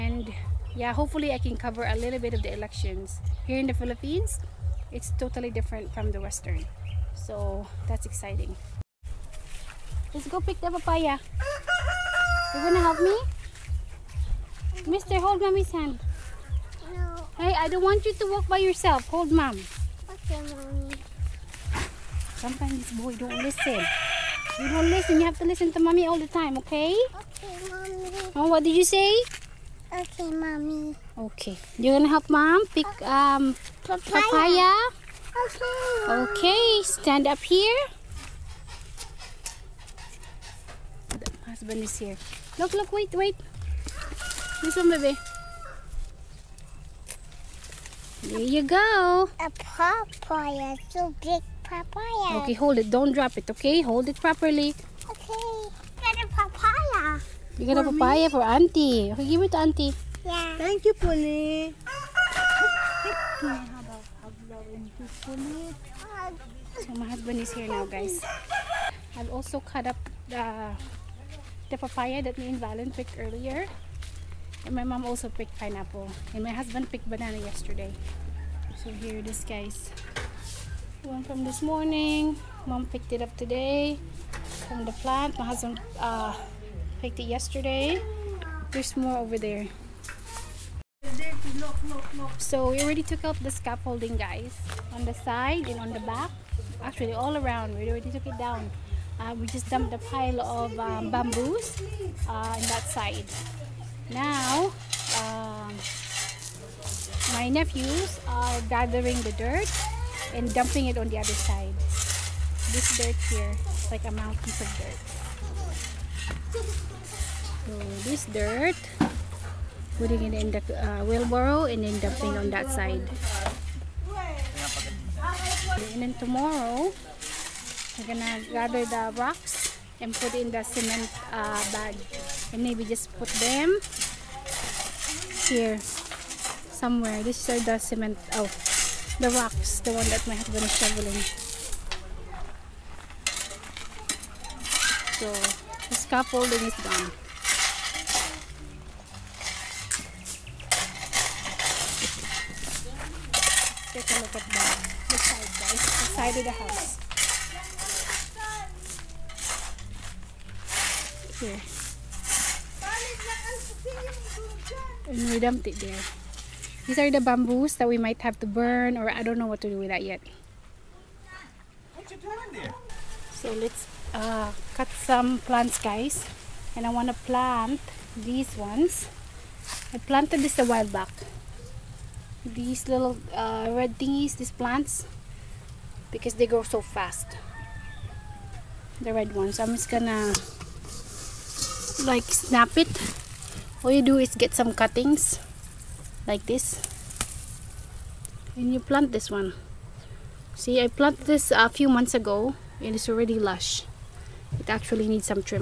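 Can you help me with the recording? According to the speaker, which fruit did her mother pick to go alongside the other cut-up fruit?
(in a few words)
Pineapple.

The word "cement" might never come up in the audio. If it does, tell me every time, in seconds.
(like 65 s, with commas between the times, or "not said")
130 s, 137 s.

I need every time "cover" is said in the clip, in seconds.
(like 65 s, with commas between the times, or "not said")
1 s.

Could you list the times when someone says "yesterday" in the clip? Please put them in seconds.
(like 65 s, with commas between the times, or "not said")
77 s, 87 s.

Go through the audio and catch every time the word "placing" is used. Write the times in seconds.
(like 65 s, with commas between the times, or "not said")
not said.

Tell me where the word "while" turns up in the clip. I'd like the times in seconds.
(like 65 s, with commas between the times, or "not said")
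180 s.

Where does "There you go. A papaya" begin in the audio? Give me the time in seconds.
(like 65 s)
48 s.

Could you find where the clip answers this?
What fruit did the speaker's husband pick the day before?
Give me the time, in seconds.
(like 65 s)
77 s.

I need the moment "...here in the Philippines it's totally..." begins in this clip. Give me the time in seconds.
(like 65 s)
3 s.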